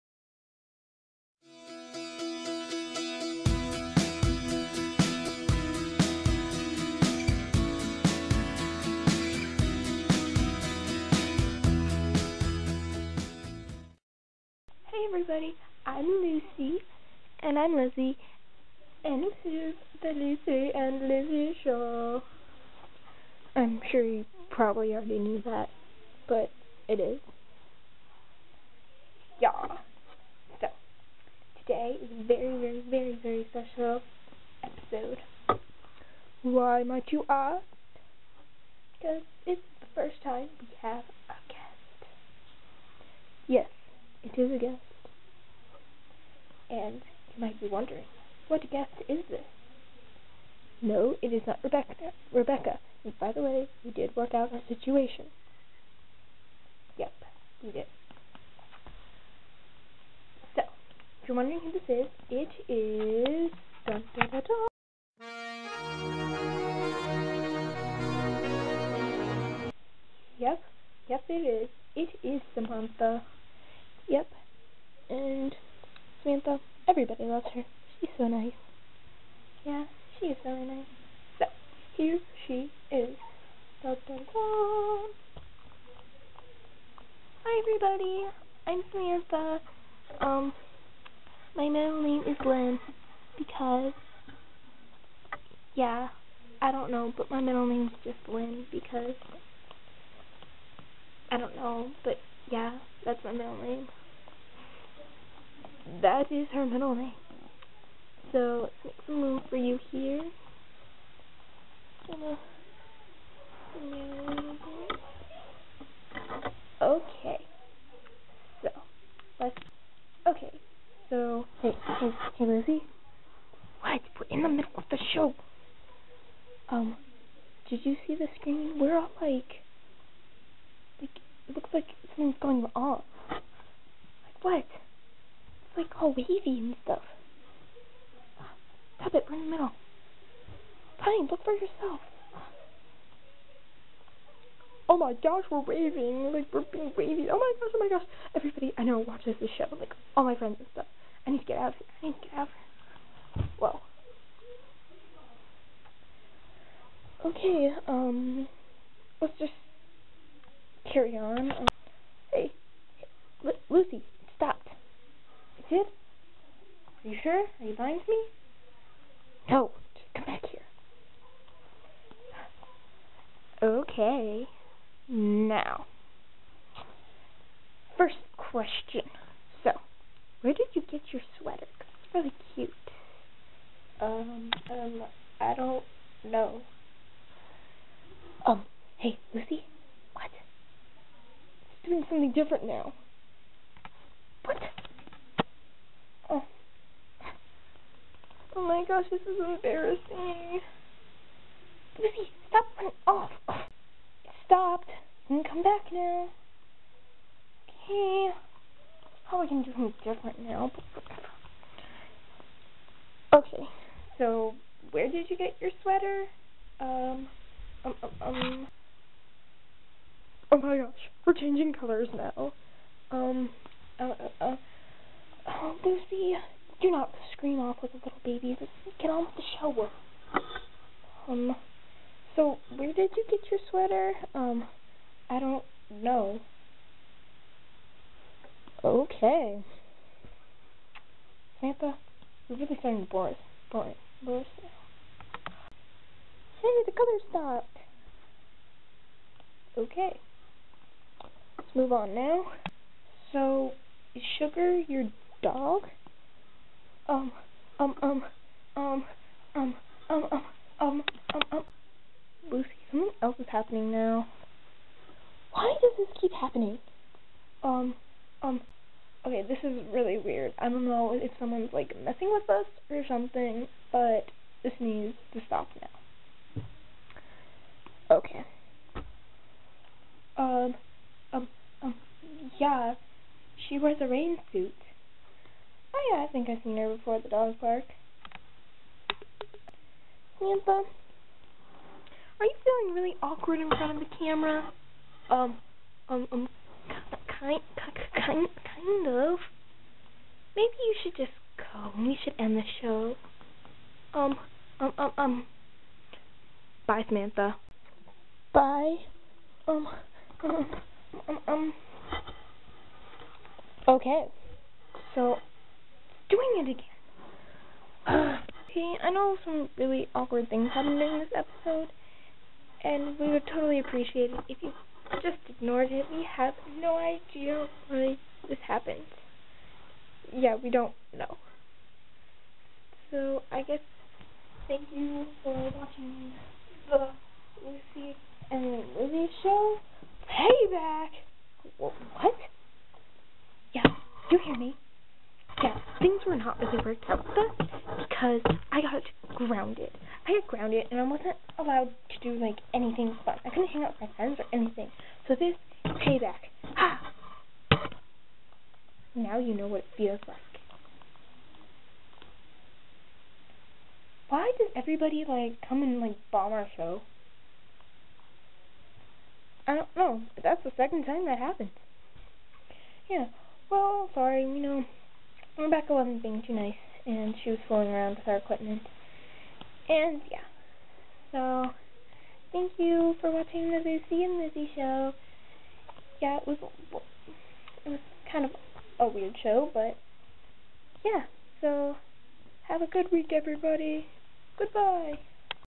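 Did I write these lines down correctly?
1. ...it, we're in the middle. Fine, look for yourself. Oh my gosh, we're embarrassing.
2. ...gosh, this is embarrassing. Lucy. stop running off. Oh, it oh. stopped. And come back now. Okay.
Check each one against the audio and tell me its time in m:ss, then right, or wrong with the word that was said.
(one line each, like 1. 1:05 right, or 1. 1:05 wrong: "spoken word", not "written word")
1. 2:19 wrong: "waving", not "embarrassing"
2. 3:18 right.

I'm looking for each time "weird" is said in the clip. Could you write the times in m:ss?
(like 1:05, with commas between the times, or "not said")
4:30, 6:29.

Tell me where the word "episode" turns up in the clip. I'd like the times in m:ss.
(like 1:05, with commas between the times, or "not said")
0:34, 5:21.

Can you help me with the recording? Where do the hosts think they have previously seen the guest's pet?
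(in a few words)
the dog park.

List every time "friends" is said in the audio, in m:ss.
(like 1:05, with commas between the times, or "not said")
2:30, 5:54.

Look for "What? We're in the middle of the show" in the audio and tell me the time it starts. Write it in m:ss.
2:03.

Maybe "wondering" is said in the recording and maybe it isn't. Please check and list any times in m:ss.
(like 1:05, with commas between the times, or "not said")
0:47, 1:01.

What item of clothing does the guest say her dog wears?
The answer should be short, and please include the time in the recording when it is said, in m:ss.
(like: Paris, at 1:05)
rain suit, at 4:44.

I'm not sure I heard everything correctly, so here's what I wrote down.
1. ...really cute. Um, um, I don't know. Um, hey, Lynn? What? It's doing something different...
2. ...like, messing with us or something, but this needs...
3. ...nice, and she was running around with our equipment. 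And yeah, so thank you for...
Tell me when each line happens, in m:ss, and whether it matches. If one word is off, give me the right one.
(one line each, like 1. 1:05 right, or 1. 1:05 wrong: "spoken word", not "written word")
1. 3:02 wrong: "Lucy", not "Lynn"
2. 4:31 right
3. 6:16 wrong: "fooling", not "running".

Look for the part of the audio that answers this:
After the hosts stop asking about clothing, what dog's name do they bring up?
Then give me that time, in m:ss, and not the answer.
4:14.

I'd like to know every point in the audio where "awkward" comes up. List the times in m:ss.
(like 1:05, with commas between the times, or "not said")
4:53, 5:20.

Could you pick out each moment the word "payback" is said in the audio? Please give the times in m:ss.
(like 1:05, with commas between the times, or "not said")
5:40, 5:56.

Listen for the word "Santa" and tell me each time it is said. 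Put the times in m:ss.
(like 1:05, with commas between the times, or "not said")
4:01.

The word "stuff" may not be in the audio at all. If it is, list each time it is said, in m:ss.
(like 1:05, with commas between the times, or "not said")
2:16, 2:30.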